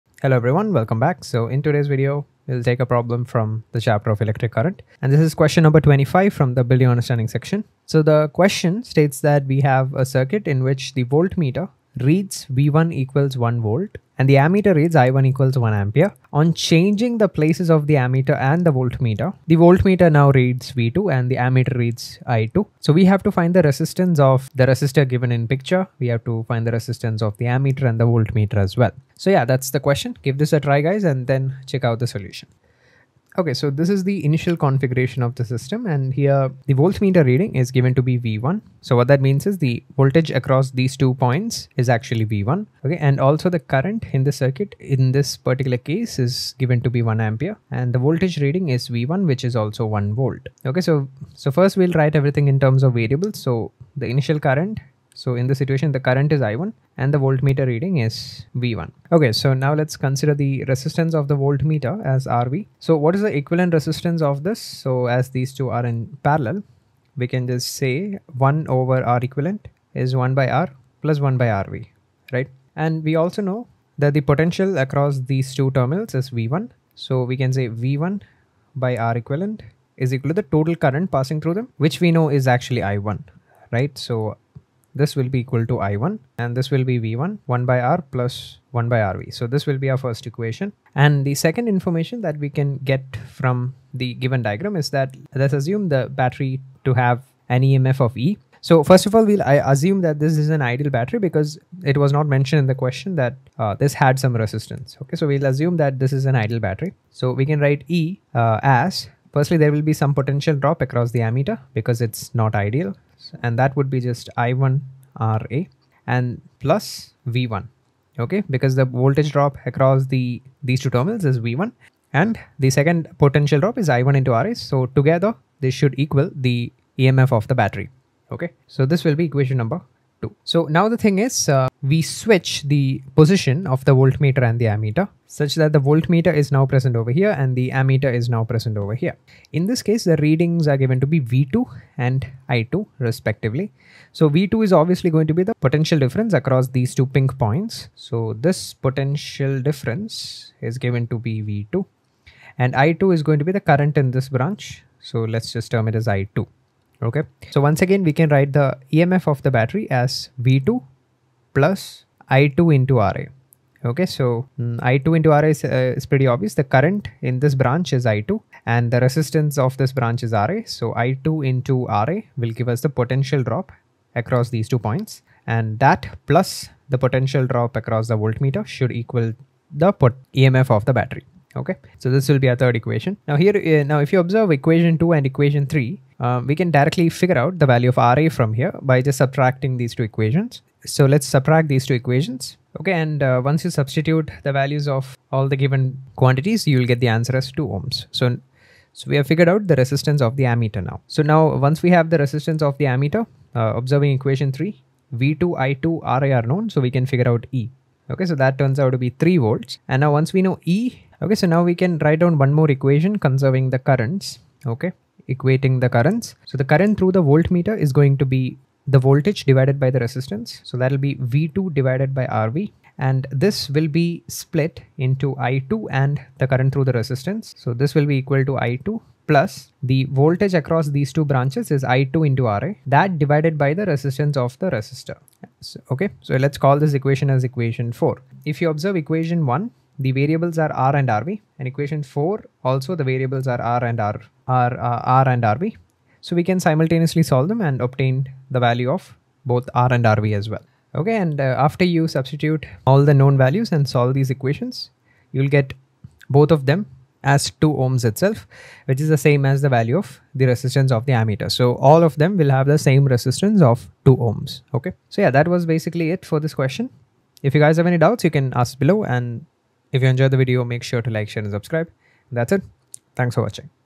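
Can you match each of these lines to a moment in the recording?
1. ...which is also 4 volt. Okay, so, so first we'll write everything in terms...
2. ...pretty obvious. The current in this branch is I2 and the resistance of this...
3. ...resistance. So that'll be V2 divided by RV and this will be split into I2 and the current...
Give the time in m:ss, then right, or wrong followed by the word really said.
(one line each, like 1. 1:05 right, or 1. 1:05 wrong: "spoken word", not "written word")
1. 0:49 wrong: "1", not "4"
2. 2:46 right
3. 3:39 right.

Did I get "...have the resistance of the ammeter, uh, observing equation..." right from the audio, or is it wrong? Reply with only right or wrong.
right.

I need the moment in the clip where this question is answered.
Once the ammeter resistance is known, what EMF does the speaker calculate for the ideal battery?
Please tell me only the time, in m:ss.
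3:29.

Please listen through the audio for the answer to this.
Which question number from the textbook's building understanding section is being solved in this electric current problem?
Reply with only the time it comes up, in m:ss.
0:05.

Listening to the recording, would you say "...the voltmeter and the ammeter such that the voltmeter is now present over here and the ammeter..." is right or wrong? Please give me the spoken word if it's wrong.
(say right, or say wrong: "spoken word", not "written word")
right.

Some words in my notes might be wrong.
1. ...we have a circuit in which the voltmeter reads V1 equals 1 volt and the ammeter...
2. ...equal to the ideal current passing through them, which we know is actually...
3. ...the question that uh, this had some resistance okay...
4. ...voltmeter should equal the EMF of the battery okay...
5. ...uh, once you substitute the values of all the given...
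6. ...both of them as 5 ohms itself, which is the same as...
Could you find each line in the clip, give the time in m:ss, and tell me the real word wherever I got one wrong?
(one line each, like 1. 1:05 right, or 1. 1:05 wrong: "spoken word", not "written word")
1. 0:09 right
2. 1:20 wrong: "total", not "ideal"
3. 1:42 right
4. 2:58 right
5. 3:13 right
6. 4:16 wrong: "2", not "5".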